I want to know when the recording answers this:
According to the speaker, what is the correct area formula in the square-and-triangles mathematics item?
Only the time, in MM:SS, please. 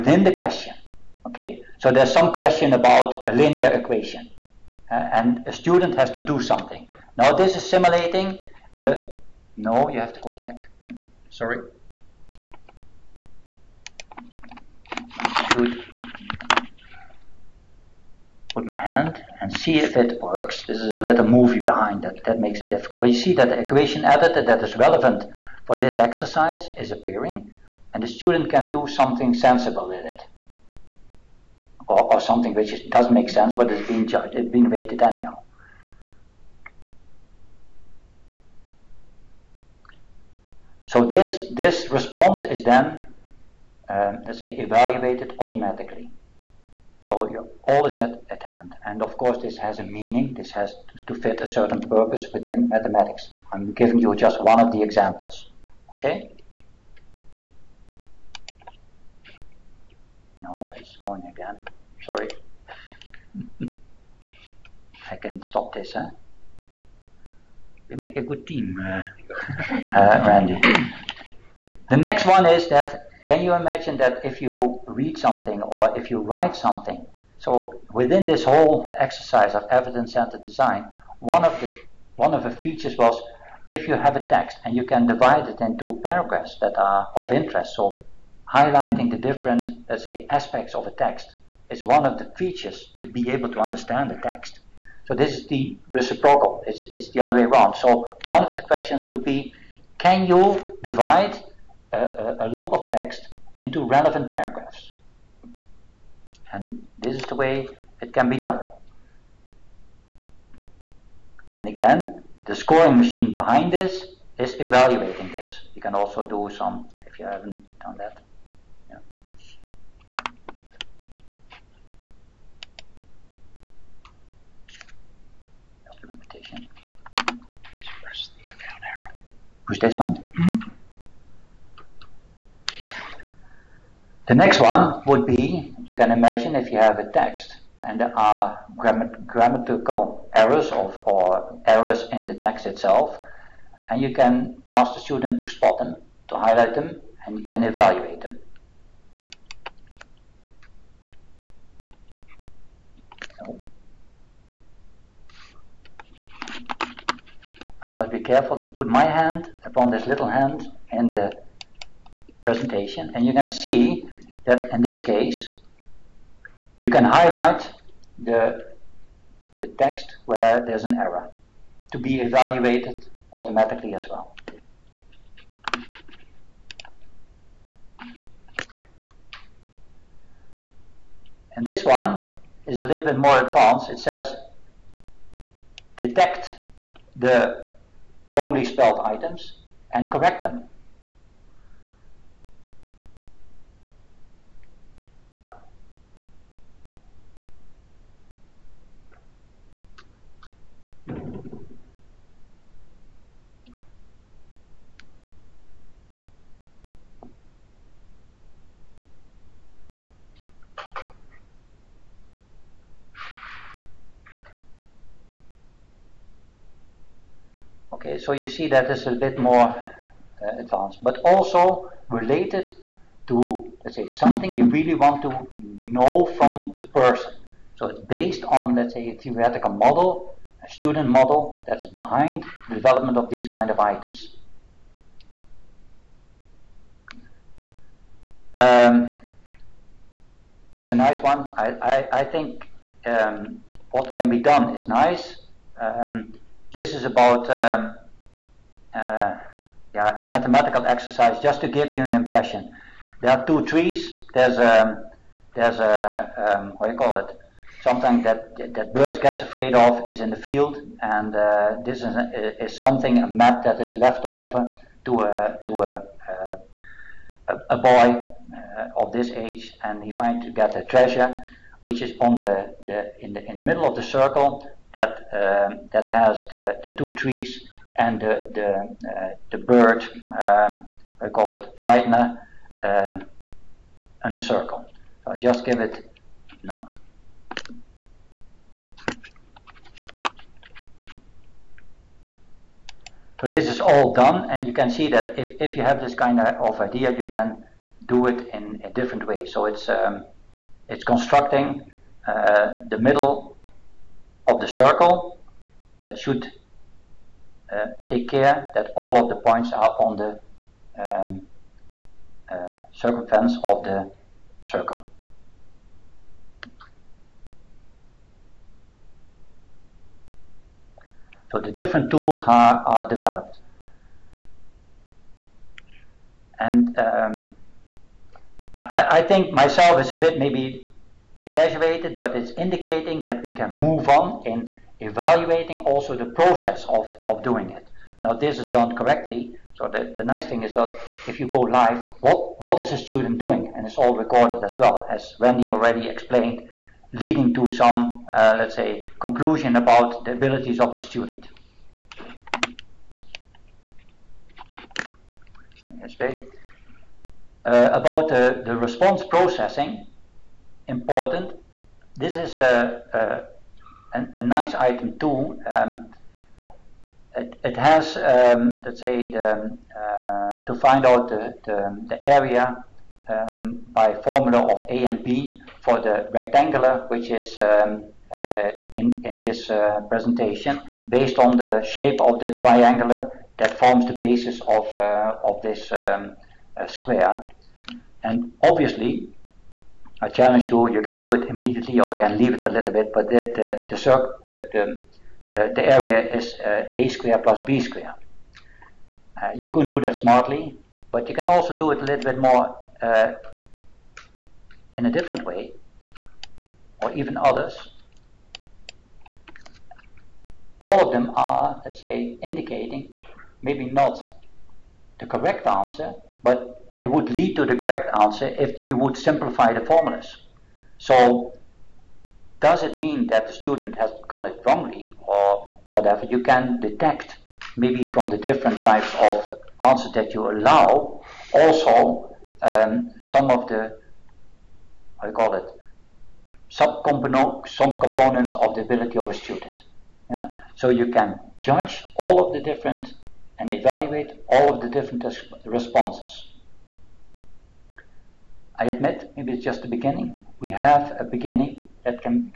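06:36.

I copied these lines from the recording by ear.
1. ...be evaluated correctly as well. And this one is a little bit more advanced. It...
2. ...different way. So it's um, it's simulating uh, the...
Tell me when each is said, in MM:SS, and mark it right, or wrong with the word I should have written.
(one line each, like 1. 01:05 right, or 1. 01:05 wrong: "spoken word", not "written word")
1. 02:51 wrong: "automatically", not "correctly"
2. 04:58 wrong: "constructing", not "simulating".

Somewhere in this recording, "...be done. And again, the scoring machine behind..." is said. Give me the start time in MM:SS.
01:48.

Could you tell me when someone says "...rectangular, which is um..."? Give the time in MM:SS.
06:16.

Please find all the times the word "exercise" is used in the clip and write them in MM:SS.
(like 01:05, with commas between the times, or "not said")
00:25, 01:18, 04:10.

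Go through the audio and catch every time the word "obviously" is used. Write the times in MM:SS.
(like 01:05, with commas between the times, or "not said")
06:28.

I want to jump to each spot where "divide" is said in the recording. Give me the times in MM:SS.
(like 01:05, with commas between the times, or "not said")
01:25, 01:40.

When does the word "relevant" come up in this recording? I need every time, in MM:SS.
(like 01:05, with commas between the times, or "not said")
00:24, 01:43.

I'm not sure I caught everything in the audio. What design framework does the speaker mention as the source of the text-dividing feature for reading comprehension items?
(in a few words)
evidence-centered design.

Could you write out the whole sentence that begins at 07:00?
So does it mean that the student has gone it wrongly or whatever?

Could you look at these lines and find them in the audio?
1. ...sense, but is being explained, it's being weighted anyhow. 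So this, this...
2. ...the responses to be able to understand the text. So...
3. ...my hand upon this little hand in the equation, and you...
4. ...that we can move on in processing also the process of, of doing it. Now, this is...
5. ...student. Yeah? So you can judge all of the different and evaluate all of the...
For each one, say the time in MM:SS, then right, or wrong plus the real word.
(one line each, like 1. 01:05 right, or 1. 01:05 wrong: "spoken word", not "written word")
1. 00:33 wrong: "judged", not "explained"
2. 01:32 wrong: "features", not "responses"
3. 02:38 wrong: "presentation", not "equation"
4. 05:33 wrong: "evaluating", not "processing"
5. 07:19 right.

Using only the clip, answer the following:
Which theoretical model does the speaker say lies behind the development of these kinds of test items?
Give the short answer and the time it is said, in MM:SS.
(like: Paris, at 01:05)
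student model, at 03:50.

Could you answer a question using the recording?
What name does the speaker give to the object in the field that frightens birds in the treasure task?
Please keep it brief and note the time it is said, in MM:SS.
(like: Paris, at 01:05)
Friedner, at 04:41.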